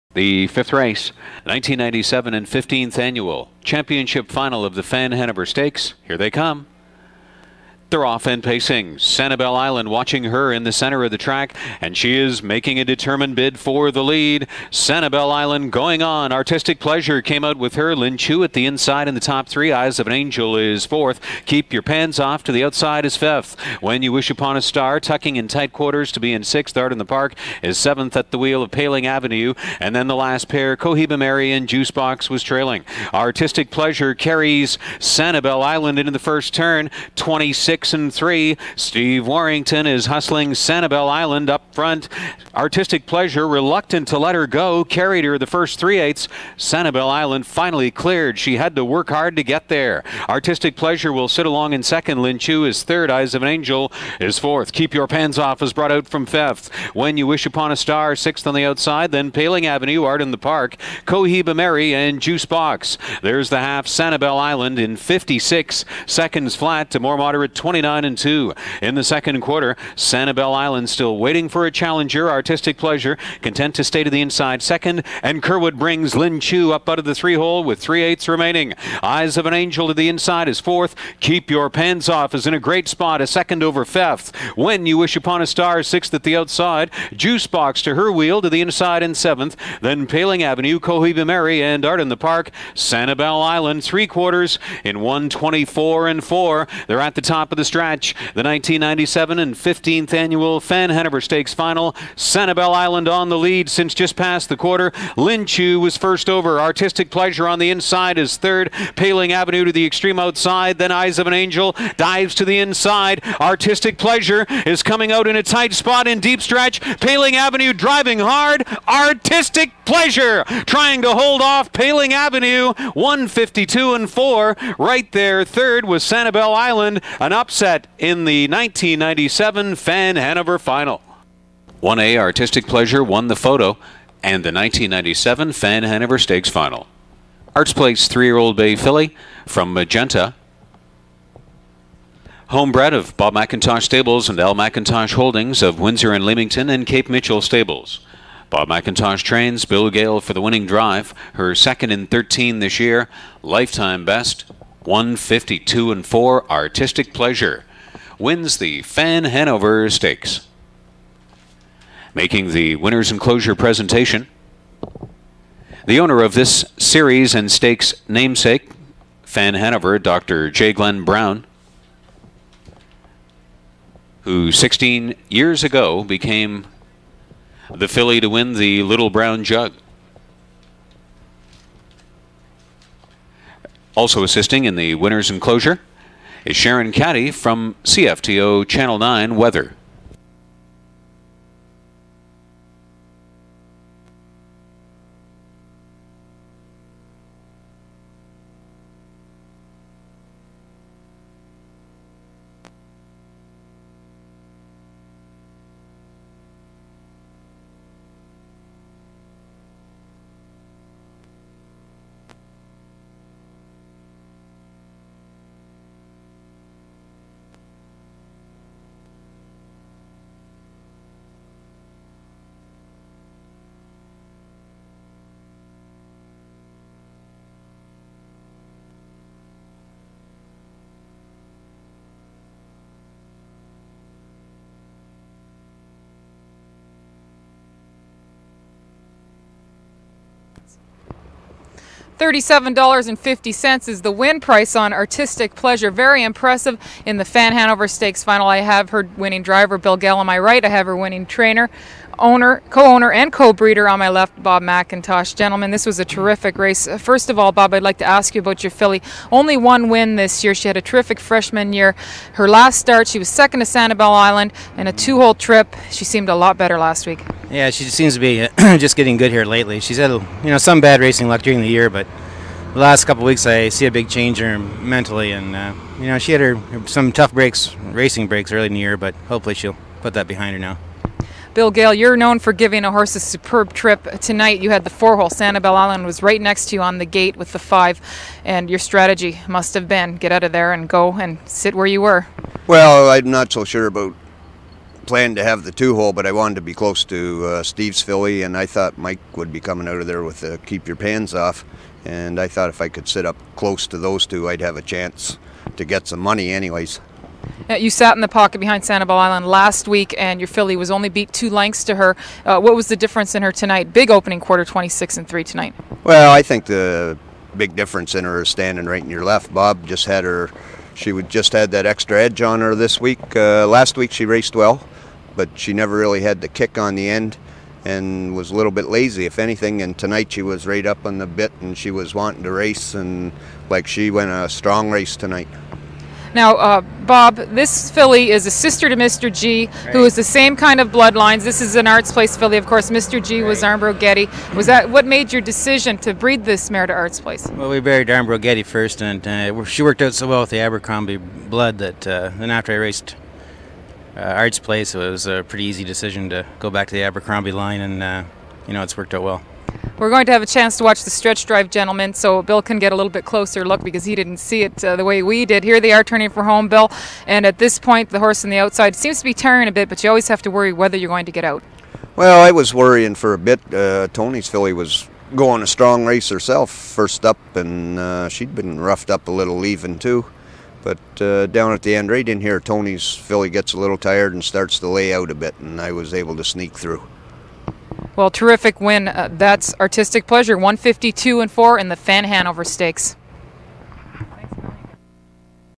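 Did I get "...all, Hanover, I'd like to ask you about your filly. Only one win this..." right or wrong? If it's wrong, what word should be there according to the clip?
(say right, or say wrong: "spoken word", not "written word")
wrong: "Bob", not "Hanover".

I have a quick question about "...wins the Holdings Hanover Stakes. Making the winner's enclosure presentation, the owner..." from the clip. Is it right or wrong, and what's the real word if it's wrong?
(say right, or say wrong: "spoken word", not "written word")
wrong: "Fan", not "Holdings".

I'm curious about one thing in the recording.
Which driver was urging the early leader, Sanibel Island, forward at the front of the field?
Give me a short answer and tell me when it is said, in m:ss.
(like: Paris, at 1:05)
Steve Warrington, at 0:38.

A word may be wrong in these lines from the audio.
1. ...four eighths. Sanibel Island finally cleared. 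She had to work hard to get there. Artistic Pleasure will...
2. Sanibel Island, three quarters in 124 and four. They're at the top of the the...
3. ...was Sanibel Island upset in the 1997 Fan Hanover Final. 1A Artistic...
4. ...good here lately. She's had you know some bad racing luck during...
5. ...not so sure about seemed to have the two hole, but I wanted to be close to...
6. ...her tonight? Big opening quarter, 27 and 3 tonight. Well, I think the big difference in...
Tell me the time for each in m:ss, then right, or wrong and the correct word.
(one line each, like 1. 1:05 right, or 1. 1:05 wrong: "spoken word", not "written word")
1. 0:45 wrong: "three", not "four"
2. 1:32 right
3. 2:05 right
4. 4:29 right
5. 4:53 wrong: "planned", not "seemed"
6. 5:13 wrong: "26", not "27".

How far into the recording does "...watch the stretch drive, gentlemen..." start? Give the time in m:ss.
6:00.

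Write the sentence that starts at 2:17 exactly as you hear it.
Artsplace three-year-old Bay filly from Magenta.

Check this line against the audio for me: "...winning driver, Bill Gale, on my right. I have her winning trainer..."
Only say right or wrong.
right.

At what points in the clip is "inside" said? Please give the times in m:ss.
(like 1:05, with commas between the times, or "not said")
0:18, 1:14, 1:20, 1:28, 1:47, 1:52.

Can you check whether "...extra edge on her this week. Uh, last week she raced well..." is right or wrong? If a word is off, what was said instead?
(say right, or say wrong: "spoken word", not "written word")
right.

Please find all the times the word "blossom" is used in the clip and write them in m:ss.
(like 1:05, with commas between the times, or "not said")
not said.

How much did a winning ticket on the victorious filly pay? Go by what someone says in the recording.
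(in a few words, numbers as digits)
$37.50.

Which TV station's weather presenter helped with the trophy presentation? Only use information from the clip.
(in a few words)
CFTO Channel 9.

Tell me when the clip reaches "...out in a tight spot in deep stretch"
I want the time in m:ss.
1:55.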